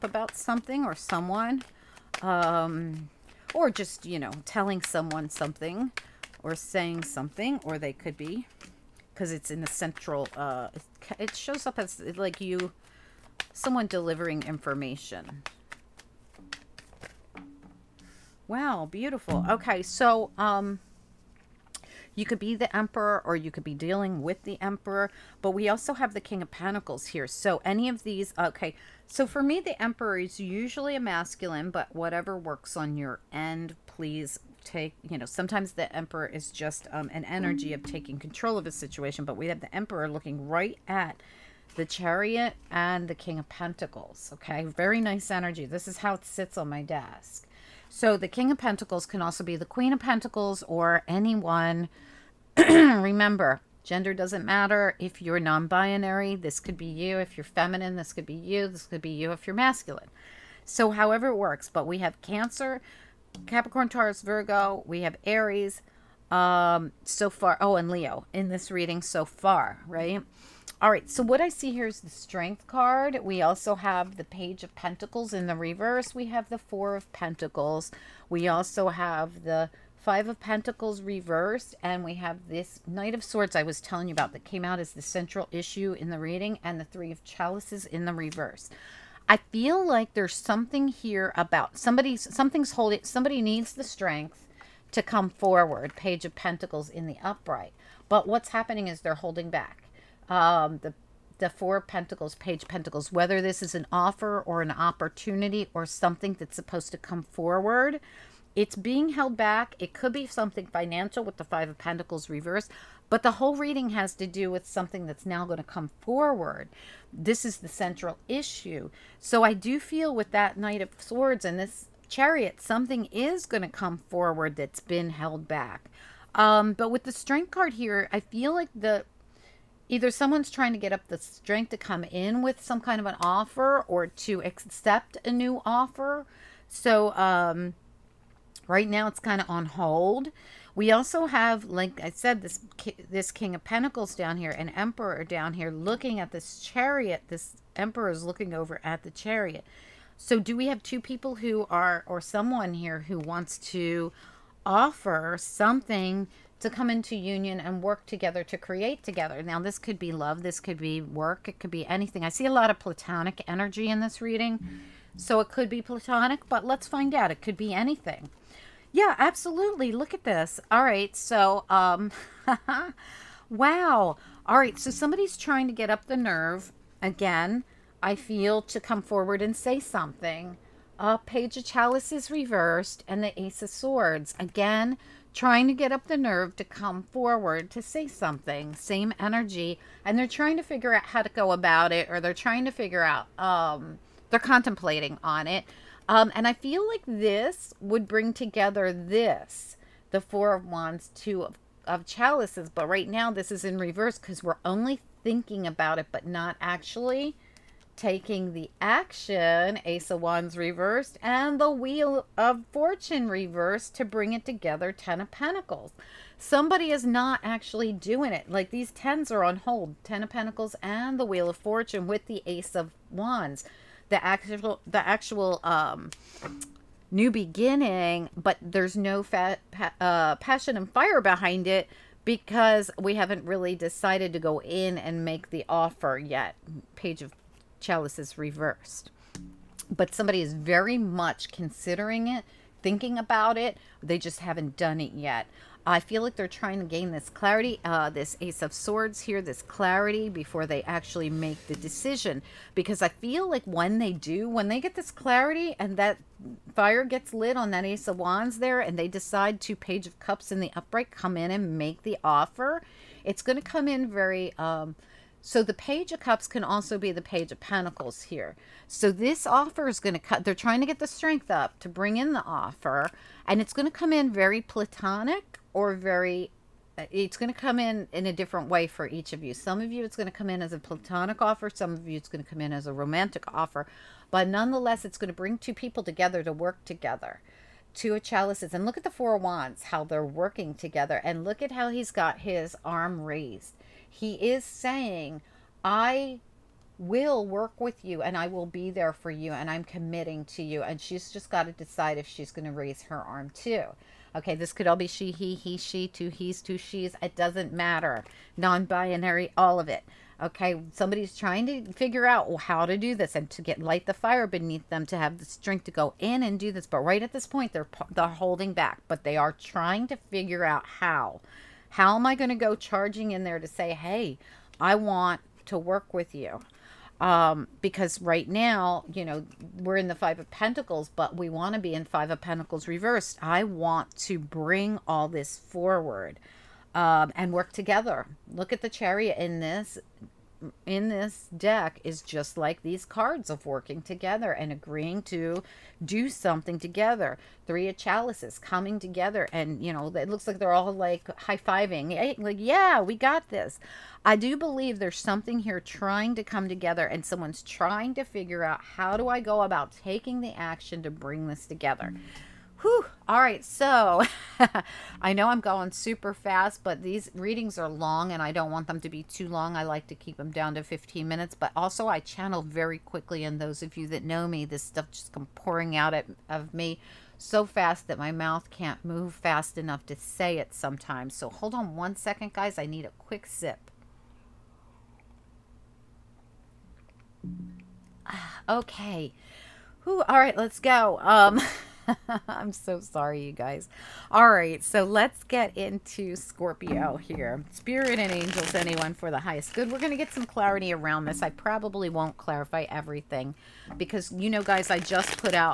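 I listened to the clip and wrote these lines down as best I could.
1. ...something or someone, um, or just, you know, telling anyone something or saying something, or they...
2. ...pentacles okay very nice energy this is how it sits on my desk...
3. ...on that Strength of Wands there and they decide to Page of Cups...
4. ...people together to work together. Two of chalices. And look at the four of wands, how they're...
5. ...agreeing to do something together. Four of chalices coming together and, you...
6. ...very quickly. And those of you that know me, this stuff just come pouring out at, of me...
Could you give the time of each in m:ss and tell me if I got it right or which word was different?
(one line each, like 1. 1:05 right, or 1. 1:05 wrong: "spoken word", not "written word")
1. 0:00 wrong: "someone", not "anyone"
2. 0:43 right
3. 4:17 wrong: "Ace", not "Strength"
4. 4:45 right
5. 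5:44 wrong: "Three", not "Four"
6. 6:12 right.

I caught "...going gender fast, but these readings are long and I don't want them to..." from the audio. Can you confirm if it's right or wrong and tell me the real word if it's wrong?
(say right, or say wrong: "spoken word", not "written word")
wrong: "super", not "gender".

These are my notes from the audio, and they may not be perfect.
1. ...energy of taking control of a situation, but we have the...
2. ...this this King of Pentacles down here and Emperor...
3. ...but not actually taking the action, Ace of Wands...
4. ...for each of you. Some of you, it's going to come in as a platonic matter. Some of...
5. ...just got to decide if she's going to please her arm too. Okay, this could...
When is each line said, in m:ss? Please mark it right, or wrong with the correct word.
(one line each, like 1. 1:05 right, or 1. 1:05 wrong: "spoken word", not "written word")
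1. 0:37 right
2. 2:22 right
3. 3:26 right
4. 4:38 wrong: "offer", not "matter"
5. 5:01 wrong: "raise", not "please".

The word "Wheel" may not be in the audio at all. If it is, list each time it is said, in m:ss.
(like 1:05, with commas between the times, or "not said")
3:31, 3:41.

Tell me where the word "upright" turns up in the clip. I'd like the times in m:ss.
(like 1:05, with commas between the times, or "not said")
1:37, 4:20.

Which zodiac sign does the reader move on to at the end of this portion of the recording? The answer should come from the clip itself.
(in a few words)
Scorpio.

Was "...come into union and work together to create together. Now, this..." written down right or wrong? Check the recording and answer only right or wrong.
right.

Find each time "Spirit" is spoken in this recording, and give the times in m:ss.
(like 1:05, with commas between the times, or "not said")
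6:37.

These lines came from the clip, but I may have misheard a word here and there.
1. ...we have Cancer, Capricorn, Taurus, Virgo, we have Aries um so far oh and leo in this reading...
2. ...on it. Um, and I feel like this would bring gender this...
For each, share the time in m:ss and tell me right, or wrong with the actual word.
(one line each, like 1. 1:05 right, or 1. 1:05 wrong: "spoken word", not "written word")
1. 1:01 right
2. 3:15 wrong: "together", not "gender".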